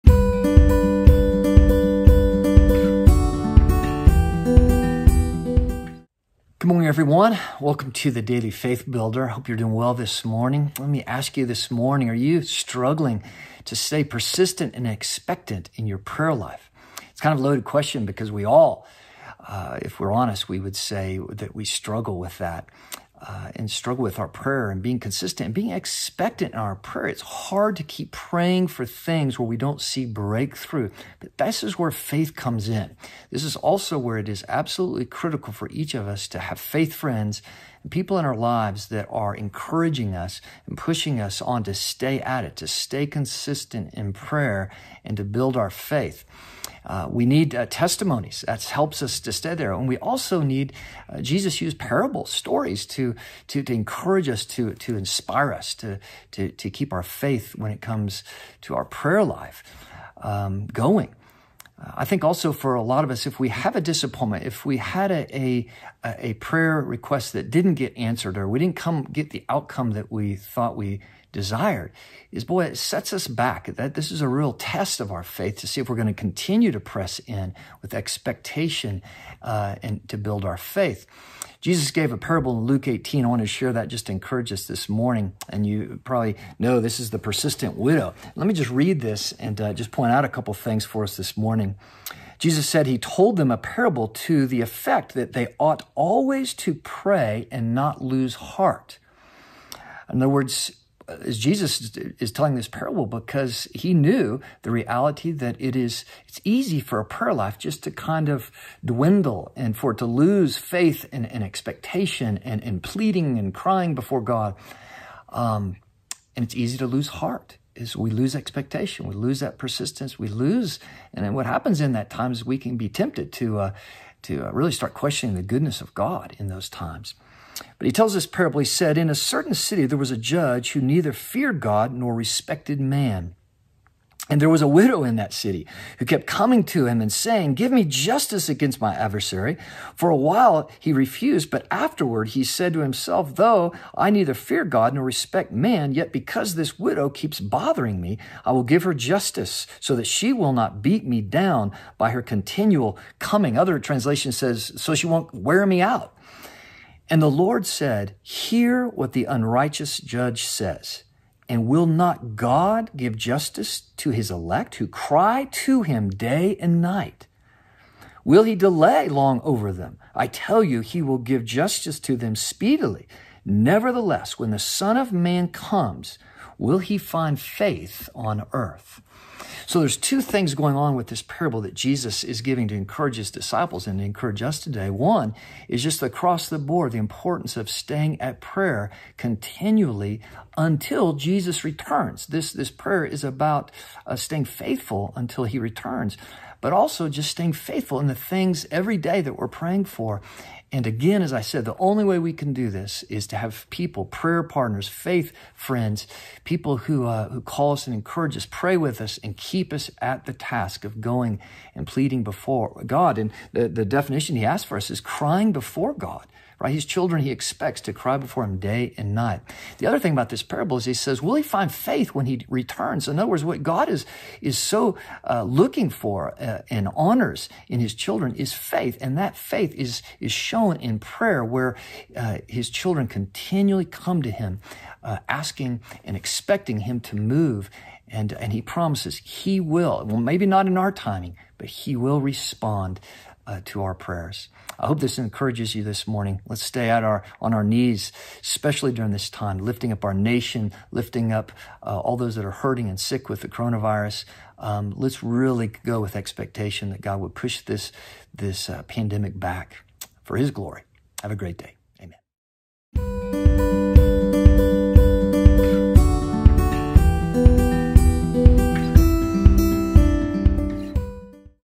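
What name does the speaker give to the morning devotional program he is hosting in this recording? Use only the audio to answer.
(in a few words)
Daily Faith Builder.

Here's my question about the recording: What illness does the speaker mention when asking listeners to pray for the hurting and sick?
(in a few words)
Coronavirus.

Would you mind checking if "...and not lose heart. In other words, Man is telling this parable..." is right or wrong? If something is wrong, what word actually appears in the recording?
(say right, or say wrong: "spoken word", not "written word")
wrong: "Jesus", not "Man".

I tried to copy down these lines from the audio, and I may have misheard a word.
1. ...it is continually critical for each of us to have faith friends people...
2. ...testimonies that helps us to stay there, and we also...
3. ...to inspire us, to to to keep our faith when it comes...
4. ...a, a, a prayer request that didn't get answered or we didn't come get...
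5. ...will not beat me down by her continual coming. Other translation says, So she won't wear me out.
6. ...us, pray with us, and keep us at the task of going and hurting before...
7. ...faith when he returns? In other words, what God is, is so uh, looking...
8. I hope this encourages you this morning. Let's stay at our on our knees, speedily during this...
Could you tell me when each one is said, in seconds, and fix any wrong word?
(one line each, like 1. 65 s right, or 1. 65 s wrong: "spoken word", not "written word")
1. 34 s wrong: "absolutely", not "continually"
2. 47 s right
3. 54 s right
4. 65 s right
5. 150 s right
6. 208 s wrong: "pleading", not "hurting"
7. 221 s right
8. 244 s wrong: "especially", not "speedily".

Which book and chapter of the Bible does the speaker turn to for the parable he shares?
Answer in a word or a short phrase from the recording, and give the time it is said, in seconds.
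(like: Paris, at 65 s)
Luke 18, at 82 s.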